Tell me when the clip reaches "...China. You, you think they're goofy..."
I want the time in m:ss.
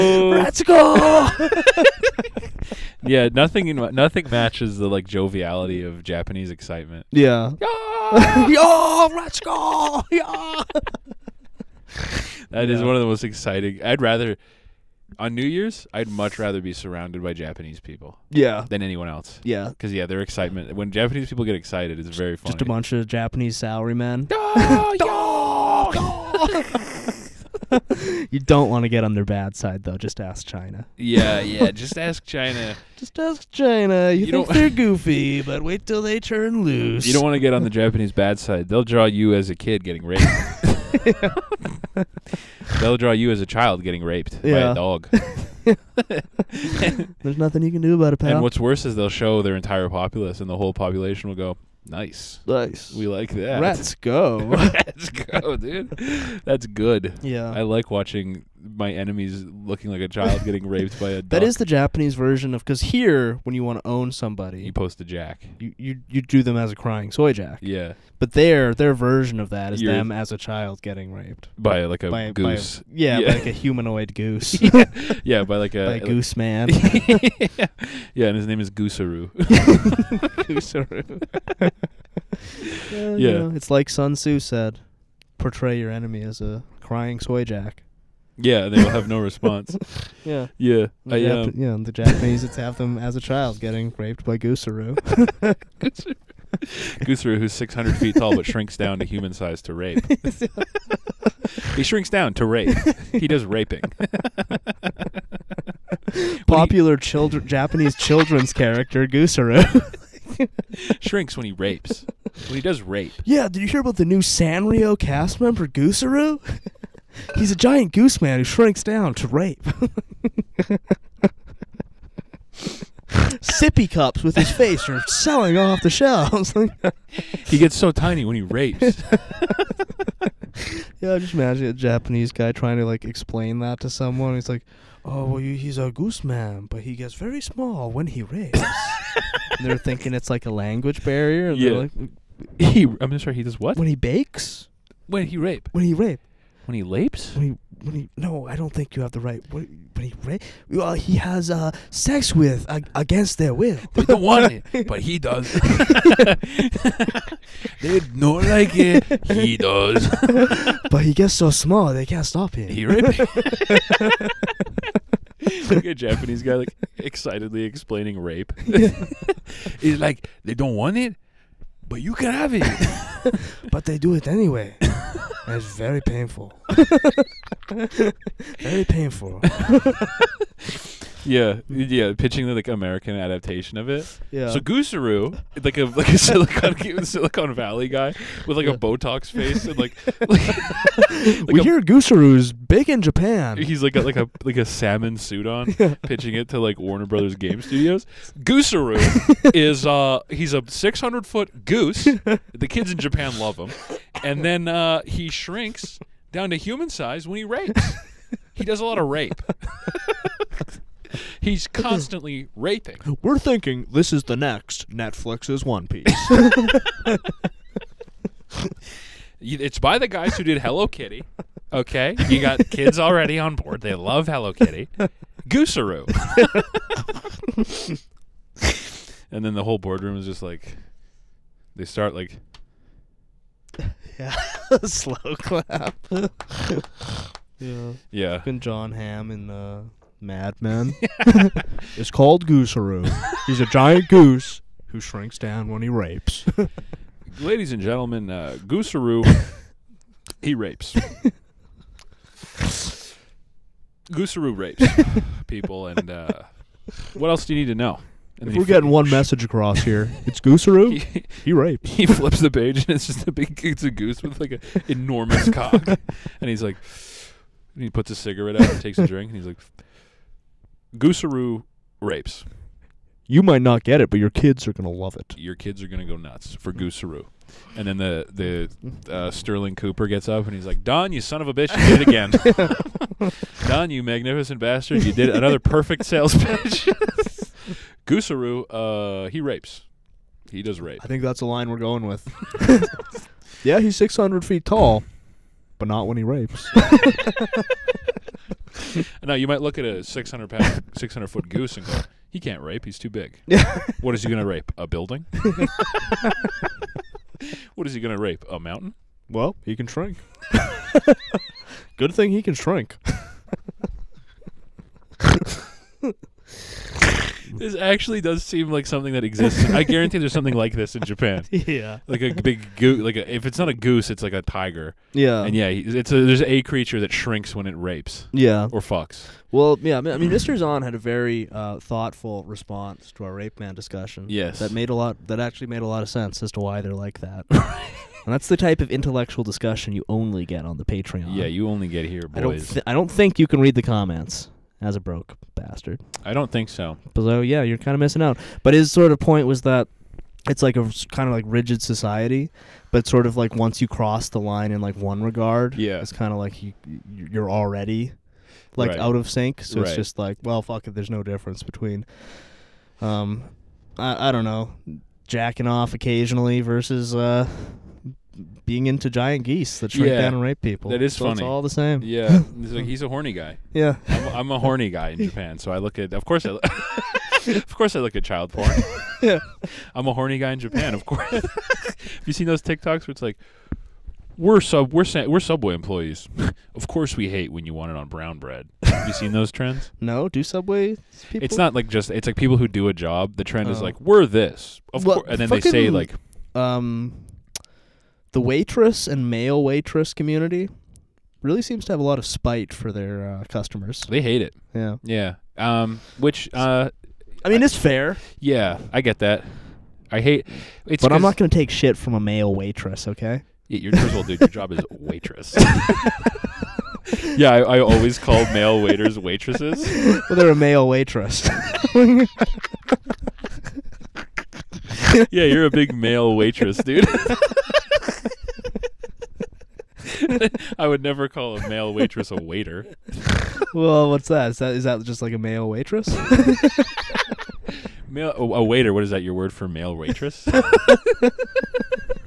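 0:33.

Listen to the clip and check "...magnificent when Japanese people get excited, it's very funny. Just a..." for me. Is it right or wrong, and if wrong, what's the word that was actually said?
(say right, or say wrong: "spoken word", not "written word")
wrong: "excitement", not "magnificent".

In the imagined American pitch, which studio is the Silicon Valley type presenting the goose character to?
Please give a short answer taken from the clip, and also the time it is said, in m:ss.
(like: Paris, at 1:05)
Warner Brothers Game Studios, at 3:16.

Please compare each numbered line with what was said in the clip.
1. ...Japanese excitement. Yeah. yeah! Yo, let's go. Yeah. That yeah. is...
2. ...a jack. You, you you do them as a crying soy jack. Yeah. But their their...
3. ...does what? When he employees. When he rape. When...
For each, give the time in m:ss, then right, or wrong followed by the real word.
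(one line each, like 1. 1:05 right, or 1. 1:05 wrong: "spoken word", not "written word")
1. 0:06 right
2. 1:04 right
3. 2:23 wrong: "bakes", not "employees".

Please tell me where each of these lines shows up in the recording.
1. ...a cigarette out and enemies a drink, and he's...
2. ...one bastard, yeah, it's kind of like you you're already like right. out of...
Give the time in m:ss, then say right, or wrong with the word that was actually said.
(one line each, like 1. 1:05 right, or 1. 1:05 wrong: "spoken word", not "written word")
1. 4:28 wrong: "takes", not "enemies"
2. 5:54 wrong: "regard", not "bastard".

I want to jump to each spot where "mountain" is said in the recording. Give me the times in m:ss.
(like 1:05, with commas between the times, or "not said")
5:08.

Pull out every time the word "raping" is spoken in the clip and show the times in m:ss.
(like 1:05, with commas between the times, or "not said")
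1:43, 3:32.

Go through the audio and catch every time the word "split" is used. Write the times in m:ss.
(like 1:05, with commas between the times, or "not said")
not said.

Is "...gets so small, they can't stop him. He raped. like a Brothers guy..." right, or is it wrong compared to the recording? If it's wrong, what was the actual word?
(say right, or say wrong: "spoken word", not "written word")
wrong: "Japanese", not "Brothers".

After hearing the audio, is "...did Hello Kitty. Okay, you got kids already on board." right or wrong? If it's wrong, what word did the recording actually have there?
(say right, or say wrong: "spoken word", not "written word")
right.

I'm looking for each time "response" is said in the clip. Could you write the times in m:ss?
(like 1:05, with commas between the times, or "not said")
1:29, 5:32.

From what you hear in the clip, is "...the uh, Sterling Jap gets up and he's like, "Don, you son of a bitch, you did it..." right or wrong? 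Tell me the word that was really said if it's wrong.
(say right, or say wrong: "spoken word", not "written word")
wrong: "Cooper", not "Jap".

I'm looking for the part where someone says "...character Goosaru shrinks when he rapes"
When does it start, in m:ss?
1:48.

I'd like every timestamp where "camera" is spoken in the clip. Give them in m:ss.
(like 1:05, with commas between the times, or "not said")
not said.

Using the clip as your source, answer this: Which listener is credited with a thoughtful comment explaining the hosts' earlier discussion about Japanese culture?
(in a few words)
Mr. Zahn.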